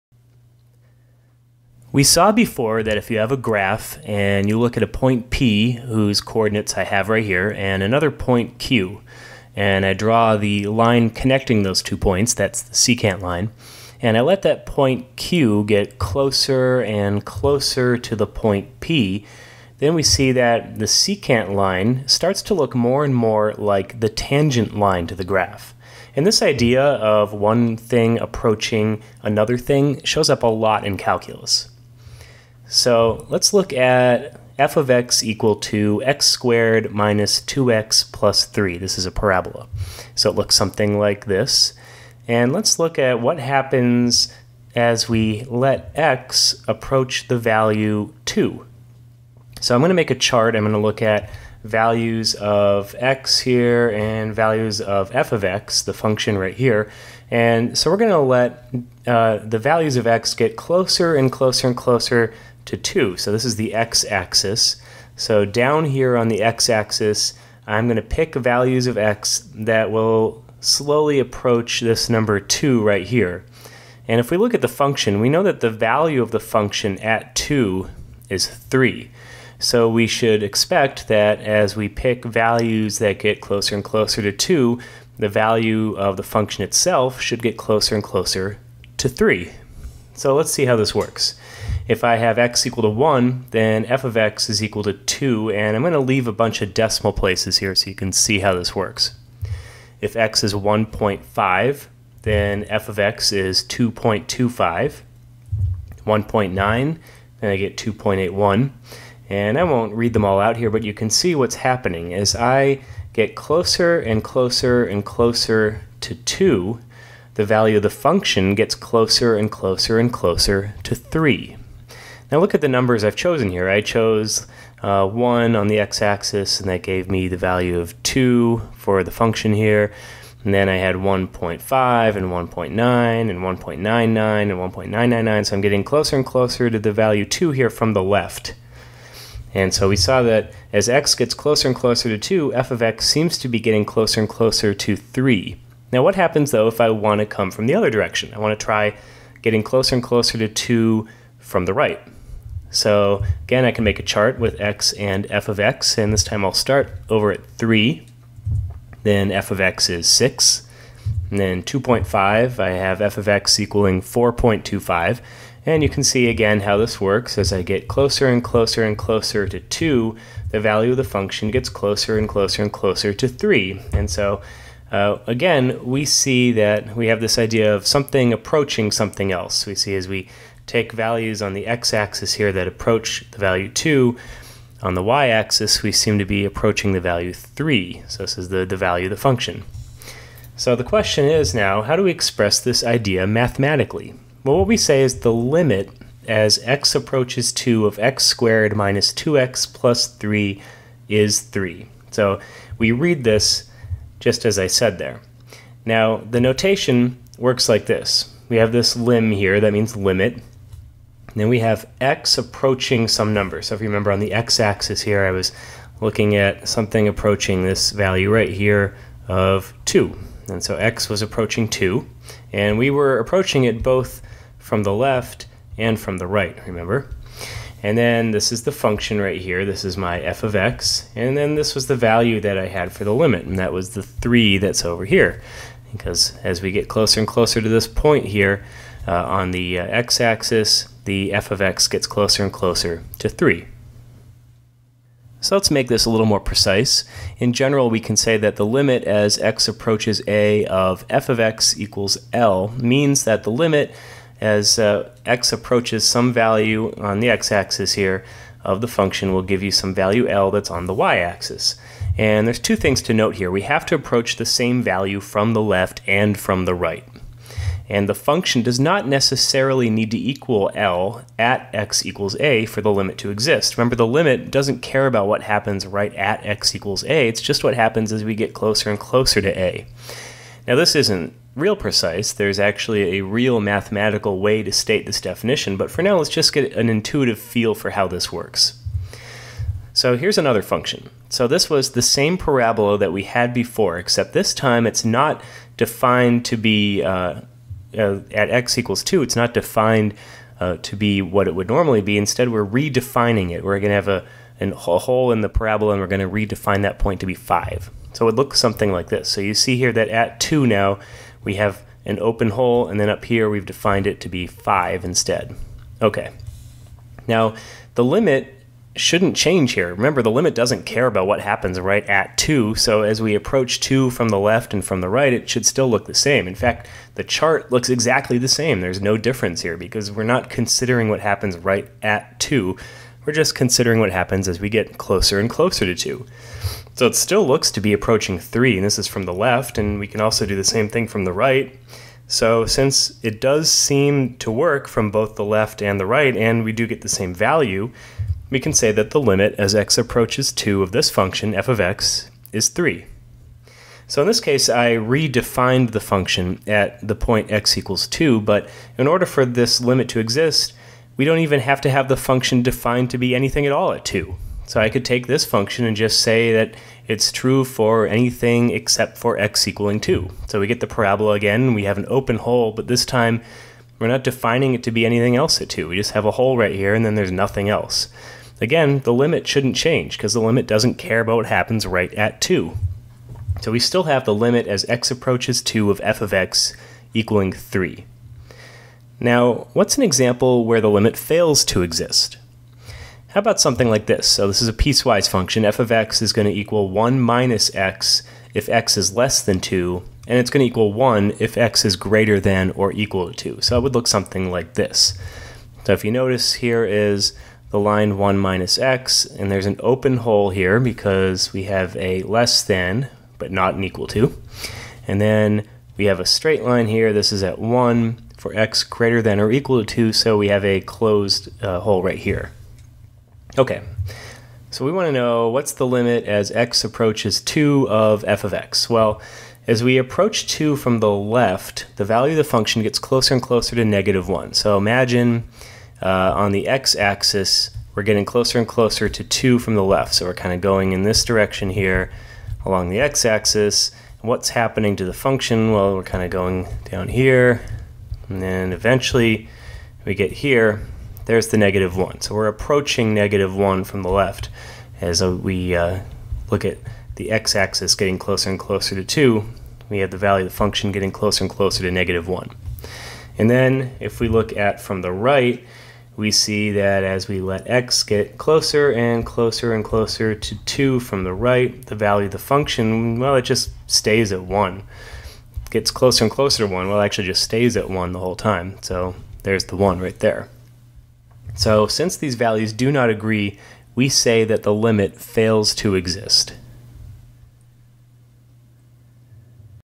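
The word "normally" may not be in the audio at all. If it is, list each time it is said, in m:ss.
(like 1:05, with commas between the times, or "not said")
5:01.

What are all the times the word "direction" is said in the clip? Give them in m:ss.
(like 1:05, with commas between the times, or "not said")
2:27, 7:21.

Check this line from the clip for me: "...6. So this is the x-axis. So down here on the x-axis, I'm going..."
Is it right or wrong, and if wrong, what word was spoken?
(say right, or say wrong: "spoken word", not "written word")
wrong: "2", not "6".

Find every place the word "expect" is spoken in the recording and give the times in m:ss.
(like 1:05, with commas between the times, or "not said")
1:20.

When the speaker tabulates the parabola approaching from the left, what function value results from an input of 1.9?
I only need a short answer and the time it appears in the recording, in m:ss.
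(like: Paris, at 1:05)
2.81, at 1:47.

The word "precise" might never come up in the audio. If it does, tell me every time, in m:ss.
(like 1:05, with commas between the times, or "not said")
4:06, 4:41.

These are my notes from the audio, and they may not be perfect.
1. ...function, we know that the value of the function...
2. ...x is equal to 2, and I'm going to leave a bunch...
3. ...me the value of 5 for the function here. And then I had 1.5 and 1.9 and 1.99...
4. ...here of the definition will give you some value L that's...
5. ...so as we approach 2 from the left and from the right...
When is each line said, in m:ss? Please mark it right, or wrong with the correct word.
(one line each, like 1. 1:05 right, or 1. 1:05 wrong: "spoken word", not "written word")
1. 1:14 right
2. 1:34 right
3. 2:07 wrong: "2", not "5"
4. 4:17 wrong: "function", not "definition"
5. 5:22 right.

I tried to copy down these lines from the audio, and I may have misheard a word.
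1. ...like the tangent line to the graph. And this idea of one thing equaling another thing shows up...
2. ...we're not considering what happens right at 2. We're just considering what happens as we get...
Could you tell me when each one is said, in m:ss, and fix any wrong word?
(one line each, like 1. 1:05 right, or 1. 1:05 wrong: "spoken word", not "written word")
1. 0:23 wrong: "approaching", not "equaling"
2. 5:30 right.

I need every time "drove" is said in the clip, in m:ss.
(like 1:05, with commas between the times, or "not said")
not said.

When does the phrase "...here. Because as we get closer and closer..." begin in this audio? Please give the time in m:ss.
3:55.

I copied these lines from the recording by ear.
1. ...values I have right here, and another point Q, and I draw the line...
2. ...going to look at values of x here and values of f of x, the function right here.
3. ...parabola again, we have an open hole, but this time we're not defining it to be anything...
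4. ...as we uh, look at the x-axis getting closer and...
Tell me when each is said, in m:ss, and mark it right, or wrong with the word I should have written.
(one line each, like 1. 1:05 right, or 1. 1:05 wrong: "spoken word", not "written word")
1. 0:06 wrong: "coordinates", not "values"
2. 0:50 right
3. 6:10 right
4. 7:35 right.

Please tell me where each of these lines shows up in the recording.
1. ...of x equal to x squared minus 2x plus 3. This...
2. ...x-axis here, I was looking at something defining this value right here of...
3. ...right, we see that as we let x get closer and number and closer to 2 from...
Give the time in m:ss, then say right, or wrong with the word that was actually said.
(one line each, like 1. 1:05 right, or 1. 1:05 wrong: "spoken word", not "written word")
1. 0:34 right
2. 3:34 wrong: "approaching", not "defining"
3. 7:45 wrong: "closer", not "number".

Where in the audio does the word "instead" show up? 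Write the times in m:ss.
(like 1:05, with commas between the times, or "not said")
5:02, 5:15.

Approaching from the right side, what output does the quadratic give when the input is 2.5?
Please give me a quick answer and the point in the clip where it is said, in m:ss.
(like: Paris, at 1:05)
4.25, at 2:44.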